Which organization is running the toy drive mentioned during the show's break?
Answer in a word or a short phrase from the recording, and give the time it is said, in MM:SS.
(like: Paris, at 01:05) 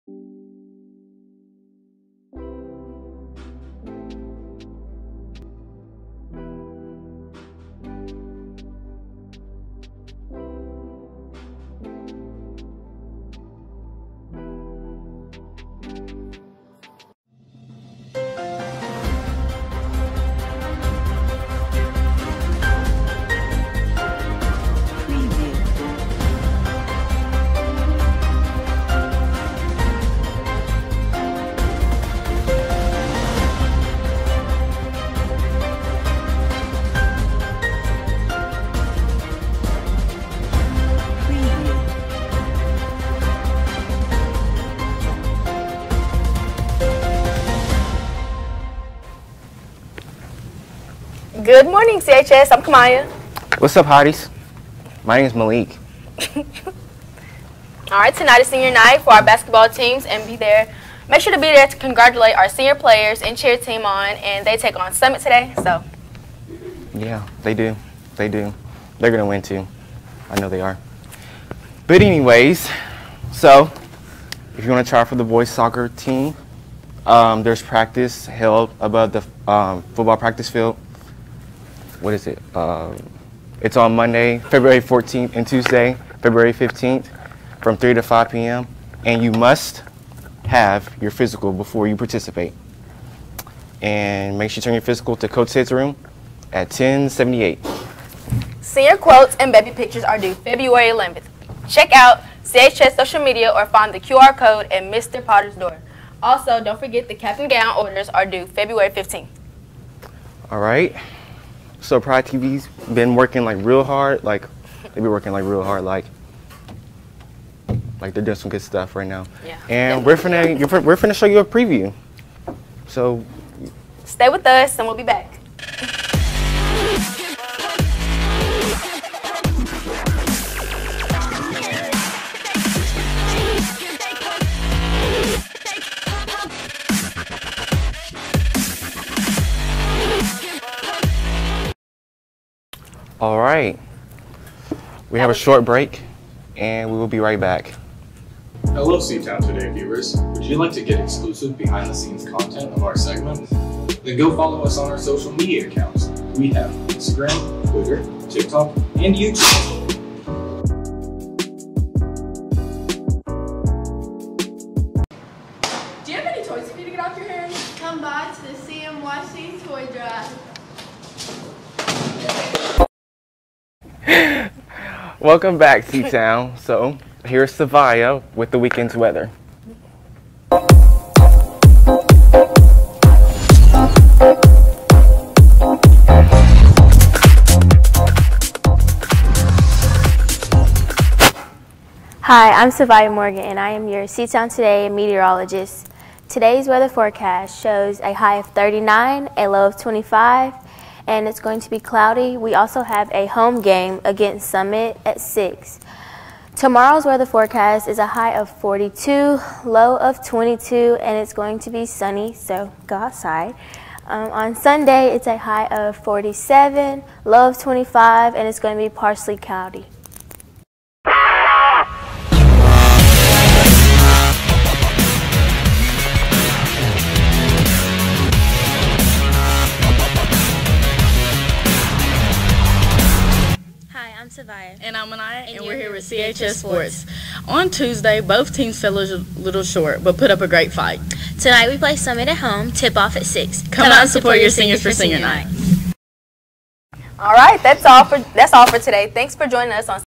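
CMYC, at 02:48.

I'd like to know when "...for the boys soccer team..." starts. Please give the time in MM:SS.
01:15.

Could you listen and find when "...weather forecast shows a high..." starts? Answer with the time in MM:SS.
03:16.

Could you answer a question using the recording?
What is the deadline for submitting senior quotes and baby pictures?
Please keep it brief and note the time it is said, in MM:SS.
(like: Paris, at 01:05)
February 11th, at 01:40.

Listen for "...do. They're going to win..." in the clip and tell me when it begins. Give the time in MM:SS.
01:08.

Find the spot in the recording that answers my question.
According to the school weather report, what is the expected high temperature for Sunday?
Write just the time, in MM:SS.
03:35.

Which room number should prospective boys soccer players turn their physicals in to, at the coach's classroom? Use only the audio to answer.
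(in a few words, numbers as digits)
1078.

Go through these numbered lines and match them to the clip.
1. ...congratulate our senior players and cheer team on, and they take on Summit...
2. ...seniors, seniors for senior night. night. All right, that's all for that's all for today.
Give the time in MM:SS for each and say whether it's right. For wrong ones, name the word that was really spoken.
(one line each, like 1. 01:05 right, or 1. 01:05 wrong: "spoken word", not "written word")
1. 01:01 right
2. 04:04 right.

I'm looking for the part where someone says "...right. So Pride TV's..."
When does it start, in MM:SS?
01:50.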